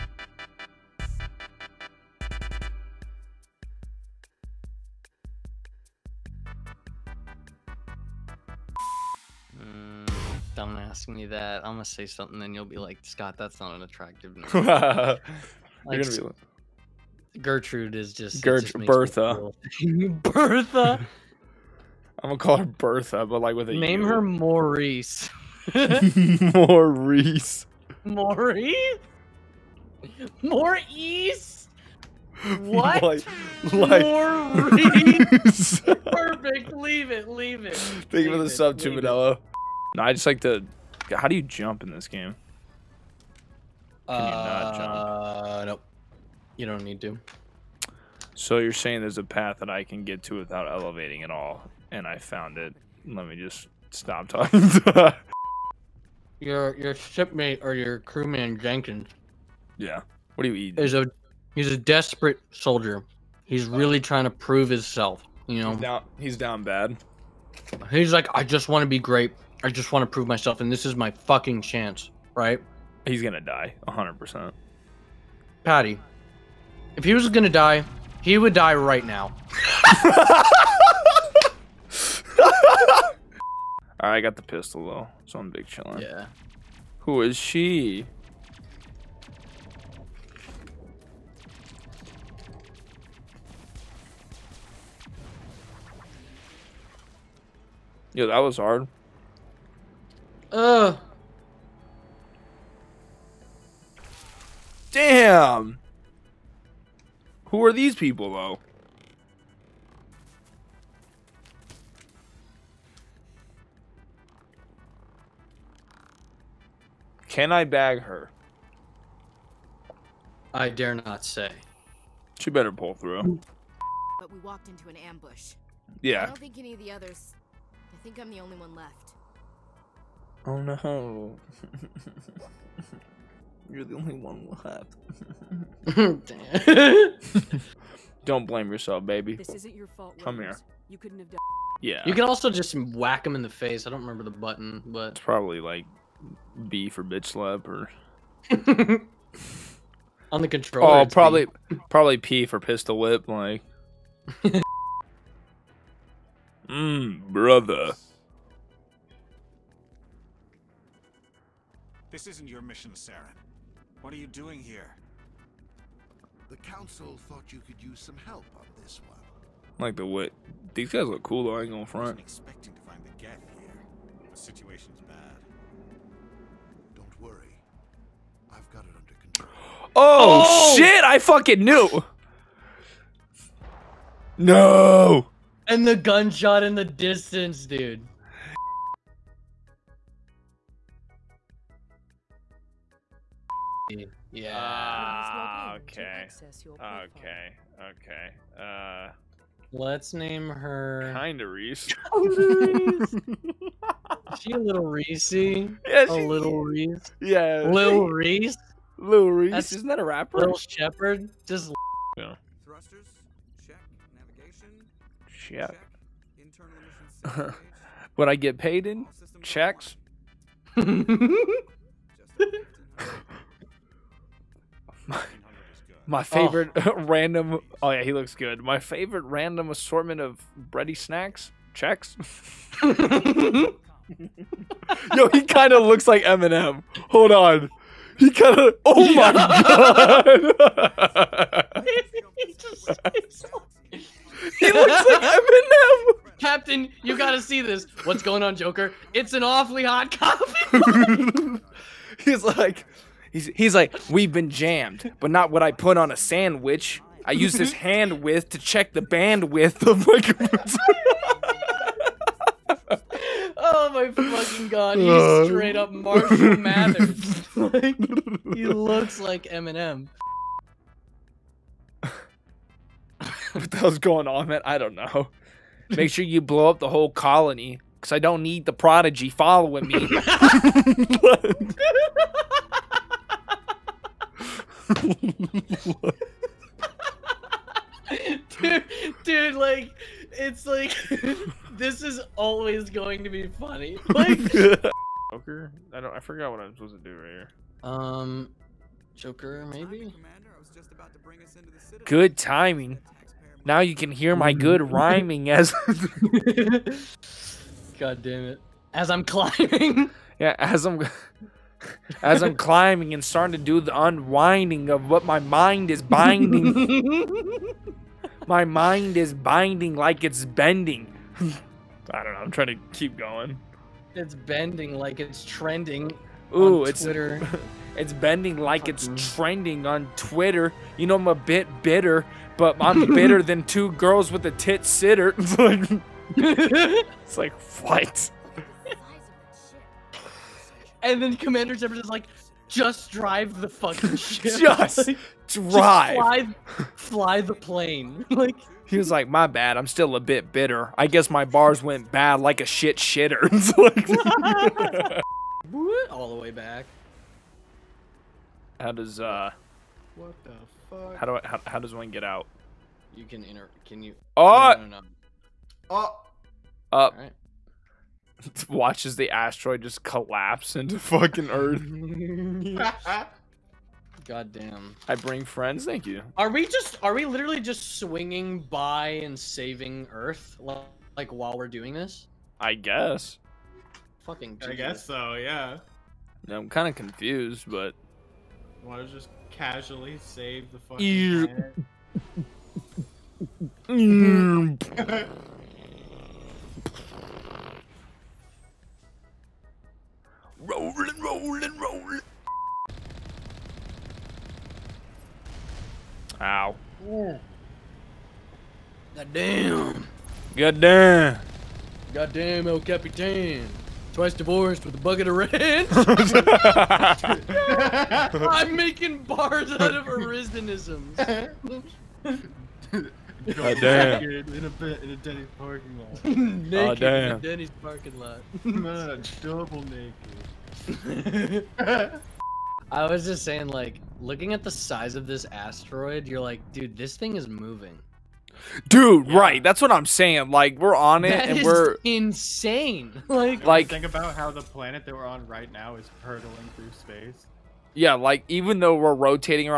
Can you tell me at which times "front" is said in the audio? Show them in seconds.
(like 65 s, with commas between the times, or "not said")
171 s.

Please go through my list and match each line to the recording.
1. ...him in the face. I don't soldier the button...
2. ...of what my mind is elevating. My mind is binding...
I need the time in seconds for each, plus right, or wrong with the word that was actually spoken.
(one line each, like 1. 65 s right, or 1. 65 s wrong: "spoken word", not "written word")
1. 143 s wrong: "remember", not "soldier"
2. 314 s wrong: "binding", not "elevating".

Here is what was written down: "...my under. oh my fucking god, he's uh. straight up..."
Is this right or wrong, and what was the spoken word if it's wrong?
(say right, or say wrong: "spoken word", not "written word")
wrong: "computer", not "under".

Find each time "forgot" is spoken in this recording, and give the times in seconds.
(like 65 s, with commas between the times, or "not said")
296 s.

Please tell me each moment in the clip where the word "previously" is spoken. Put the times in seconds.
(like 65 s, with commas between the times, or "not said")
not said.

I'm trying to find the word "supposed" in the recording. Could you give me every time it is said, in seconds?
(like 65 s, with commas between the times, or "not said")
296 s.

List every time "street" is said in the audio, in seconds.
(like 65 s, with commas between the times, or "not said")
not said.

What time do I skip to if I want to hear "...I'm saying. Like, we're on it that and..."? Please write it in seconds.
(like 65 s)
439 s.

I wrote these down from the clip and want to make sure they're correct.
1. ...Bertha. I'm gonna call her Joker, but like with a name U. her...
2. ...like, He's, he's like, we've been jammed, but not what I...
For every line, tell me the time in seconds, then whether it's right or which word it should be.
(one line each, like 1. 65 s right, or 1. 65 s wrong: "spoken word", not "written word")
1. 20 s wrong: "Bertha", not "Joker"
2. 252 s right.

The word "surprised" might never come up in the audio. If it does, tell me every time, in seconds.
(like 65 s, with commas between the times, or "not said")
not said.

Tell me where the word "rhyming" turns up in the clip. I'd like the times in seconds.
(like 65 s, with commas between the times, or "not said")
304 s.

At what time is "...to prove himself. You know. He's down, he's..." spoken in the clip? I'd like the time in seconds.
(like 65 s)
64 s.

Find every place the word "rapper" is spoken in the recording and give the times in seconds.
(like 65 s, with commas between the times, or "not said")
210 s.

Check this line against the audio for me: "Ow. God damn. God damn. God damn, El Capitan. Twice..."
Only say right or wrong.
right.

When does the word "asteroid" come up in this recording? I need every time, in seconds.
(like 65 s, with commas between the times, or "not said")
369 s, 435 s.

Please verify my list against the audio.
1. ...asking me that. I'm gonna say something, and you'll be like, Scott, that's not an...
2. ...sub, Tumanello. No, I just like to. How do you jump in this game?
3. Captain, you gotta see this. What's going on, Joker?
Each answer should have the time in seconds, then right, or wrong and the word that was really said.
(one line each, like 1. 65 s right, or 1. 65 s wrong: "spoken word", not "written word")
1. 10 s right
2. 38 s right
3. 246 s right.